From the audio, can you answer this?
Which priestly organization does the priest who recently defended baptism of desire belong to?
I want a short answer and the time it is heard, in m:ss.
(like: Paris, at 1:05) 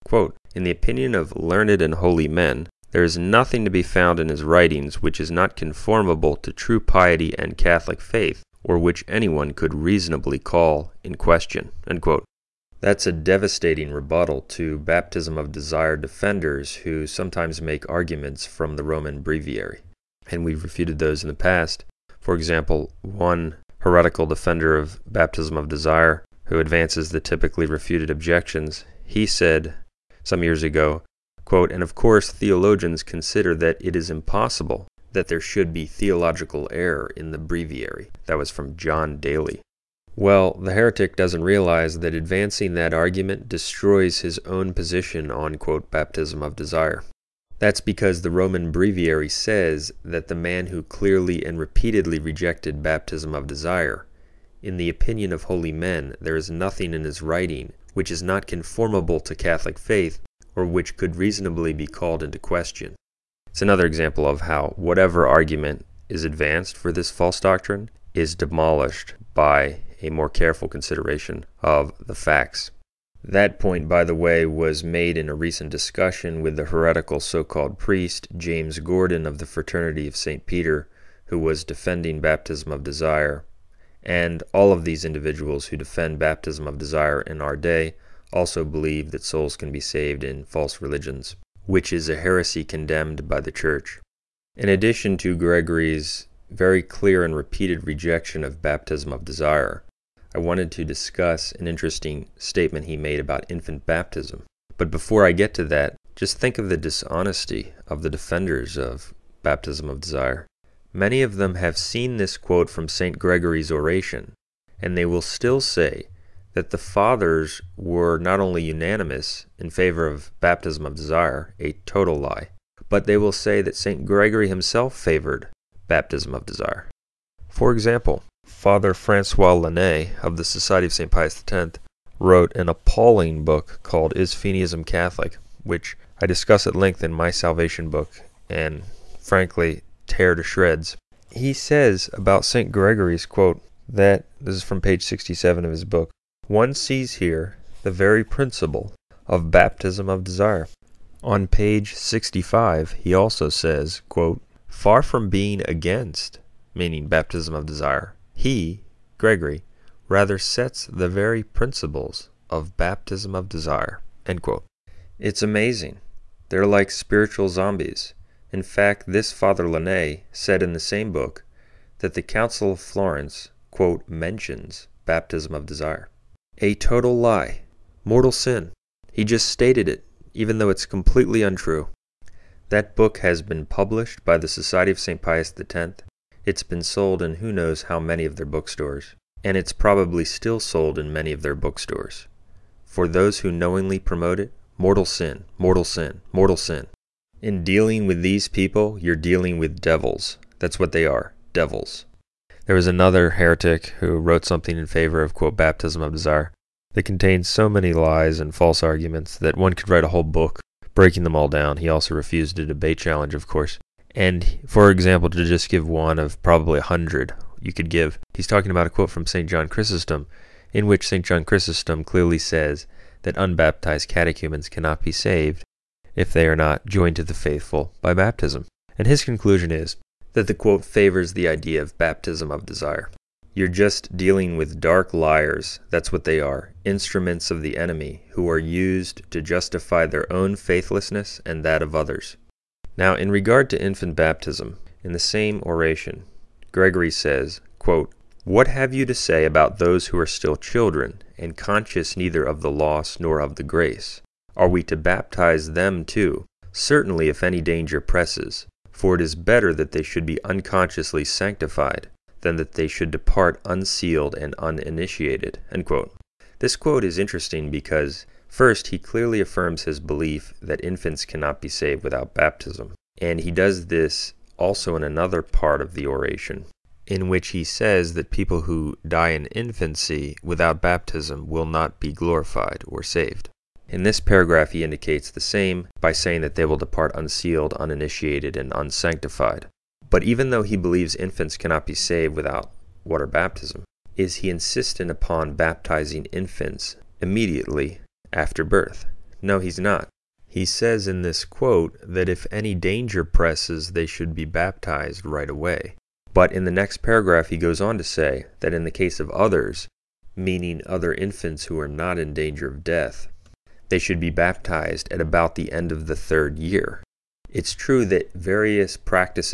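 Fraternity of St. Peter, at 1:19.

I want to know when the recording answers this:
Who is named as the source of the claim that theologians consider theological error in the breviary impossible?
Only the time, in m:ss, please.
0:38.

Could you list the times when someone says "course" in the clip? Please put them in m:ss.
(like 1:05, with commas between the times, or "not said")
0:31, 3:33.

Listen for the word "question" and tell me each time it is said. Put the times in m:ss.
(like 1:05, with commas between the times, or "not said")
0:11, 1:02.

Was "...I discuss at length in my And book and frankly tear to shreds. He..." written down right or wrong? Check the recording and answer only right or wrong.
wrong.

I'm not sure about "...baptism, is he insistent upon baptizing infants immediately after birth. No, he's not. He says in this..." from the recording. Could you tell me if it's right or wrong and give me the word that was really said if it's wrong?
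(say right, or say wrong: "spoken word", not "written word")
right.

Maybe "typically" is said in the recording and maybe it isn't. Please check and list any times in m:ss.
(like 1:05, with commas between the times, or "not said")
0:27.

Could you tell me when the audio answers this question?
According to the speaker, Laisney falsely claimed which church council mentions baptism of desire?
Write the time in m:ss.
2:52.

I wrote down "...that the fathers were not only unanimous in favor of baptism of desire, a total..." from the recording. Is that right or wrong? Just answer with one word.
right.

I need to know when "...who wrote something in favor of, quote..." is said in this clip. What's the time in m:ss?
3:24.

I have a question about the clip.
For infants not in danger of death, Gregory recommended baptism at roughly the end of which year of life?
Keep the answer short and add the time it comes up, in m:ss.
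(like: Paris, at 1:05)
3rd year, at 5:16.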